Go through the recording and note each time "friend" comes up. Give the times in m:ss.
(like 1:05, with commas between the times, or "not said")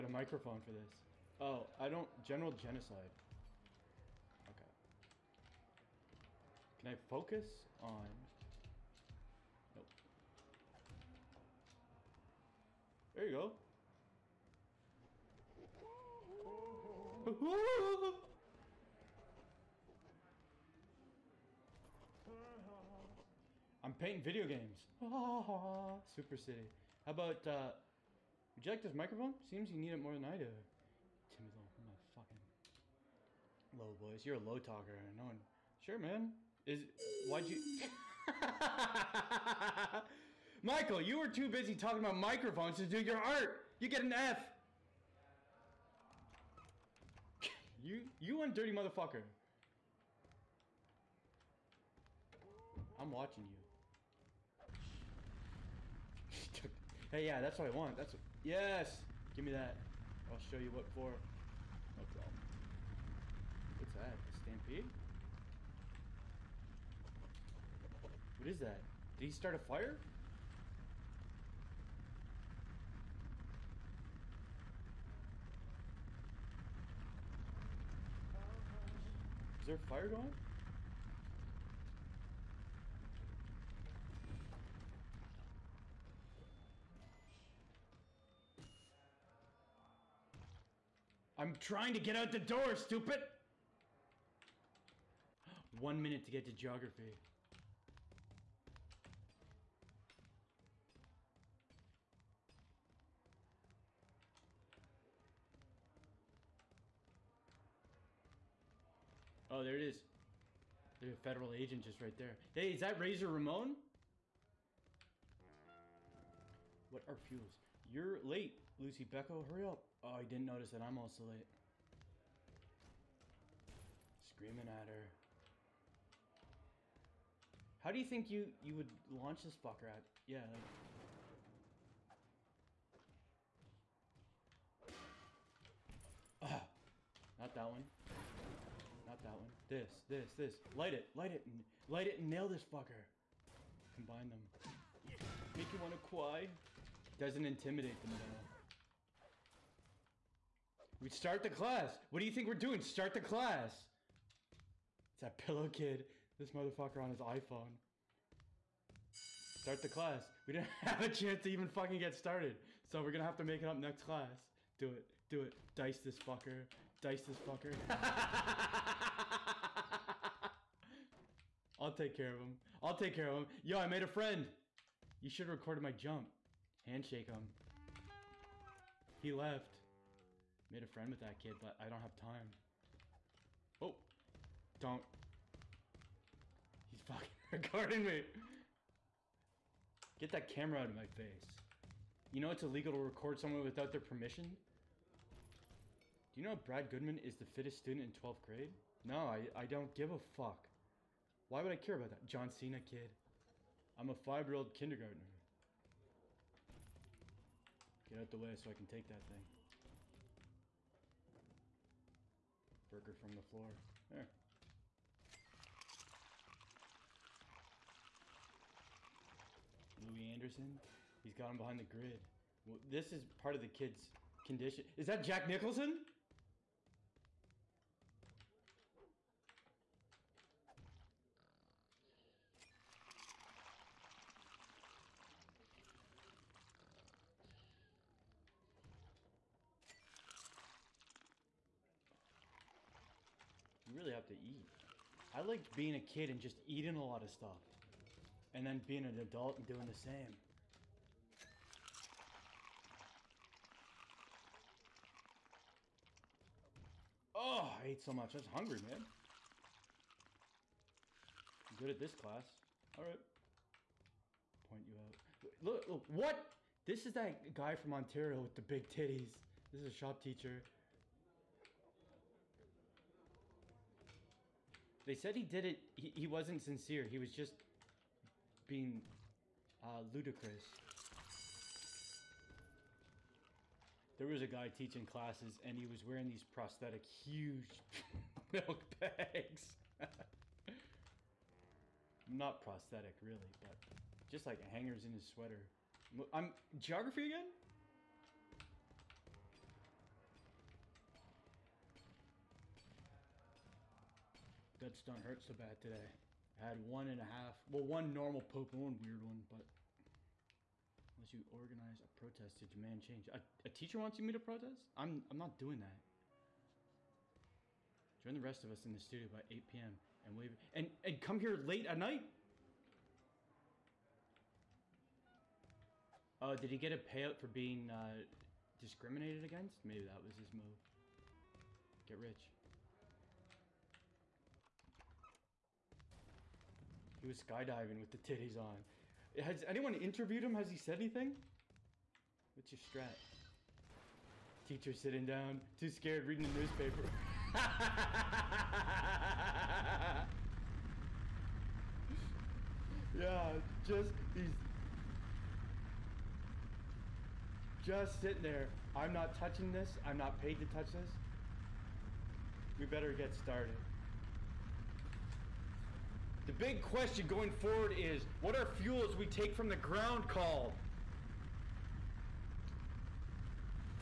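2:54, 3:00.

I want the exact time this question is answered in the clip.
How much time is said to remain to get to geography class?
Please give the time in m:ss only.
1:35.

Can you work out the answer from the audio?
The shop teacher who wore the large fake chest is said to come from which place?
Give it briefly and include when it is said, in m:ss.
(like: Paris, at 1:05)
Ontario, at 4:27.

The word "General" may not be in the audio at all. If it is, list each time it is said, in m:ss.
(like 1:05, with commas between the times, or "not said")
0:02.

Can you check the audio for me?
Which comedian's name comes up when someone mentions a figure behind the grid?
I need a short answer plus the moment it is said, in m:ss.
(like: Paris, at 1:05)
Louis Anderson, at 3:40.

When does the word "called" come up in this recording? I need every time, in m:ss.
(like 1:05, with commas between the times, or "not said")
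6:10.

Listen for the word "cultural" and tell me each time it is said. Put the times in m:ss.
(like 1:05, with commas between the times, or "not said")
not said.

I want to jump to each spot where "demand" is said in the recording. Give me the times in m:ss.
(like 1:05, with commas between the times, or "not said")
5:12.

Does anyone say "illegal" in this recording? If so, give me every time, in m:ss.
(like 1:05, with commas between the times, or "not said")
3:12.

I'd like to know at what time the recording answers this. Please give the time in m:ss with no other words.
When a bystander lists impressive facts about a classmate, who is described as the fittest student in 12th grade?
3:16.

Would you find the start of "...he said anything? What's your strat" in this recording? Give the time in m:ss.
5:40.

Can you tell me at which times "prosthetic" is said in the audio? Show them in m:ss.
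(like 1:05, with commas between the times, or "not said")
4:46, 4:52.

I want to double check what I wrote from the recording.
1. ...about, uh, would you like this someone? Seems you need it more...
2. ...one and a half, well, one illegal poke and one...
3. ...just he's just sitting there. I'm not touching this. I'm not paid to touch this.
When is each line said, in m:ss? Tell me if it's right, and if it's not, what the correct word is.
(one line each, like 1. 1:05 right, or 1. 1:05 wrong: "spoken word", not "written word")
1. 0:27 wrong: "microphone", not "someone"
2. 5:06 wrong: "normal", not "illegal"
3. 5:53 right.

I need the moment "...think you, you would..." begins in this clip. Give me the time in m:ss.
2:08.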